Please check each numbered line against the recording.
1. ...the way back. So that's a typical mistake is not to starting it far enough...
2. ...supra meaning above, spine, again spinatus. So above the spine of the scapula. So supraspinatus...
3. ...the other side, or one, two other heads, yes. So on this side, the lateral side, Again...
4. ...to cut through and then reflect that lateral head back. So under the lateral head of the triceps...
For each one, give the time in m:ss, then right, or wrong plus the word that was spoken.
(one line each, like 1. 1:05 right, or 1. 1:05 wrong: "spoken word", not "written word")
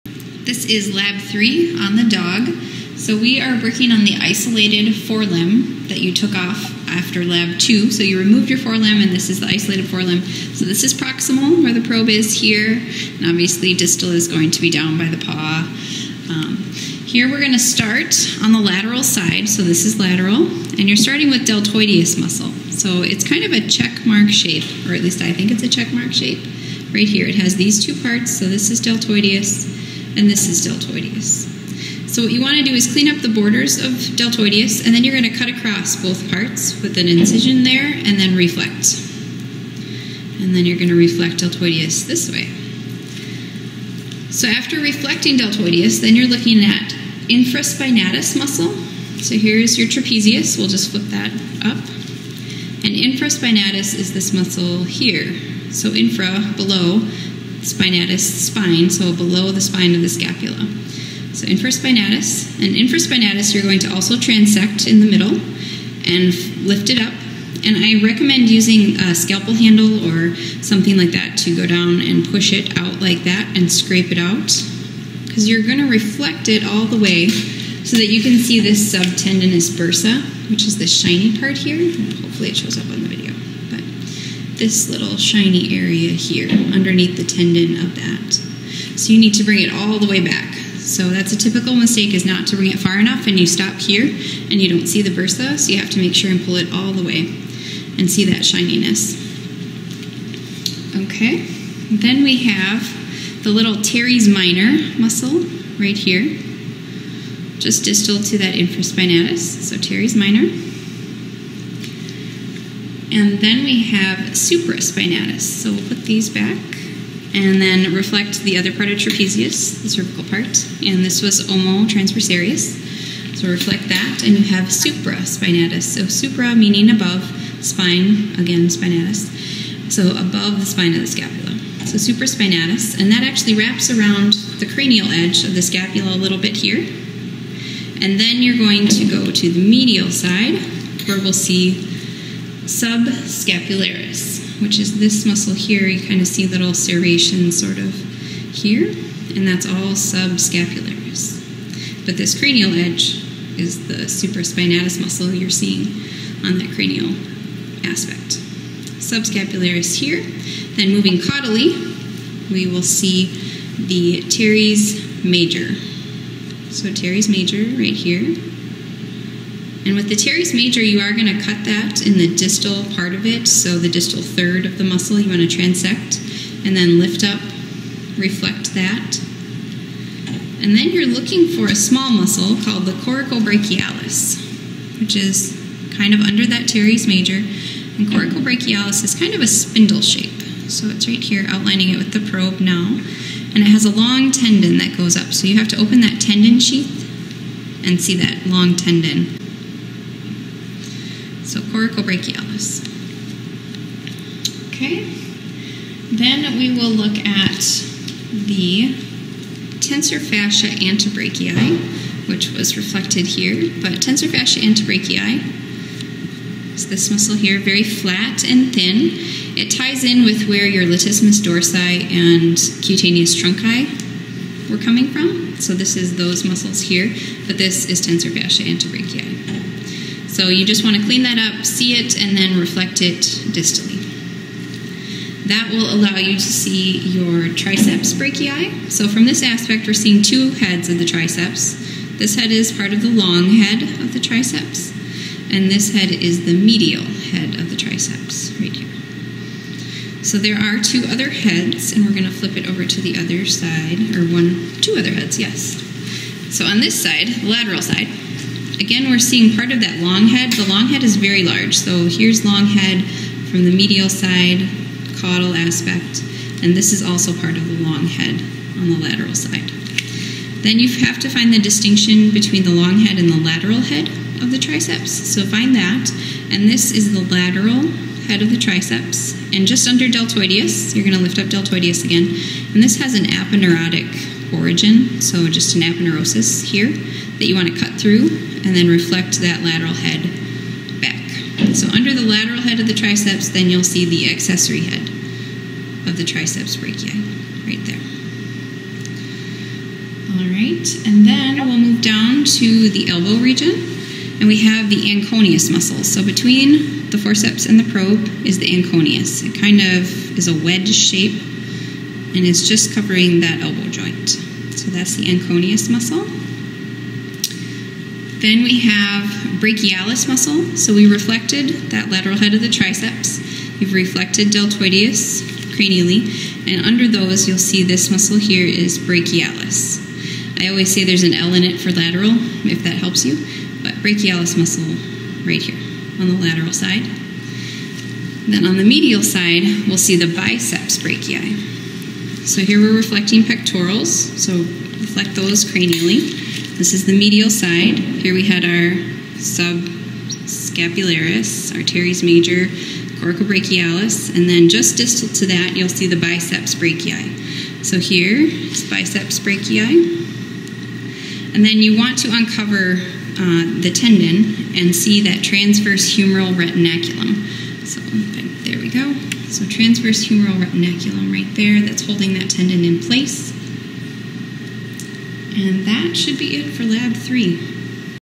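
1. 1:29 wrong: "bring", not "starting"
2. 2:06 right
3. 4:13 right
4. 4:47 right.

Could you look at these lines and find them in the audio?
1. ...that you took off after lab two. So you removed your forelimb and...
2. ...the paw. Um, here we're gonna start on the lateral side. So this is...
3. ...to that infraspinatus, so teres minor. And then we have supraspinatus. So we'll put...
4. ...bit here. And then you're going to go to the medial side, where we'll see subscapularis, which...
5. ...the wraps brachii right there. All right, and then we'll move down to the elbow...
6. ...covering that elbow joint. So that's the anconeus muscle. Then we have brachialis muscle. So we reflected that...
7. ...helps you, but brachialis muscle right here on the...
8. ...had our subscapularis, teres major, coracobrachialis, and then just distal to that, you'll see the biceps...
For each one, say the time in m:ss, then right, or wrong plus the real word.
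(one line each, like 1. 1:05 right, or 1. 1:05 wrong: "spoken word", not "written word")
1. 0:05 right
2. 0:15 right
3. 1:48 right
4. 2:16 right
5. 4:56 wrong: "triceps", not "wraps"
6. 5:12 right
7. 5:32 right
8. 5:48 right.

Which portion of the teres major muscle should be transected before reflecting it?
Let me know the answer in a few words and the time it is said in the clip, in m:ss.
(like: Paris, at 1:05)
distal third, at 2:53.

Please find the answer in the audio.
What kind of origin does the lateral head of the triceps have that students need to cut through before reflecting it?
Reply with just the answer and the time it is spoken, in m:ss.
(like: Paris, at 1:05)
aponeurotic origin, at 4:43.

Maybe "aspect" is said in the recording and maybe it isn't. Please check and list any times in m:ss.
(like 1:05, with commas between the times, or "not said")
2:37, 3:59, 4:25.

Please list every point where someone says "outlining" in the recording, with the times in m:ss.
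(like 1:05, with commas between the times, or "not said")
3:11.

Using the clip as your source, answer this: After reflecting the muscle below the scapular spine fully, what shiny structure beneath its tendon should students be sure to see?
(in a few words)
subtendinous bursa.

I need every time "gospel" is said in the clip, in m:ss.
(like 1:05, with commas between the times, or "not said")
not said.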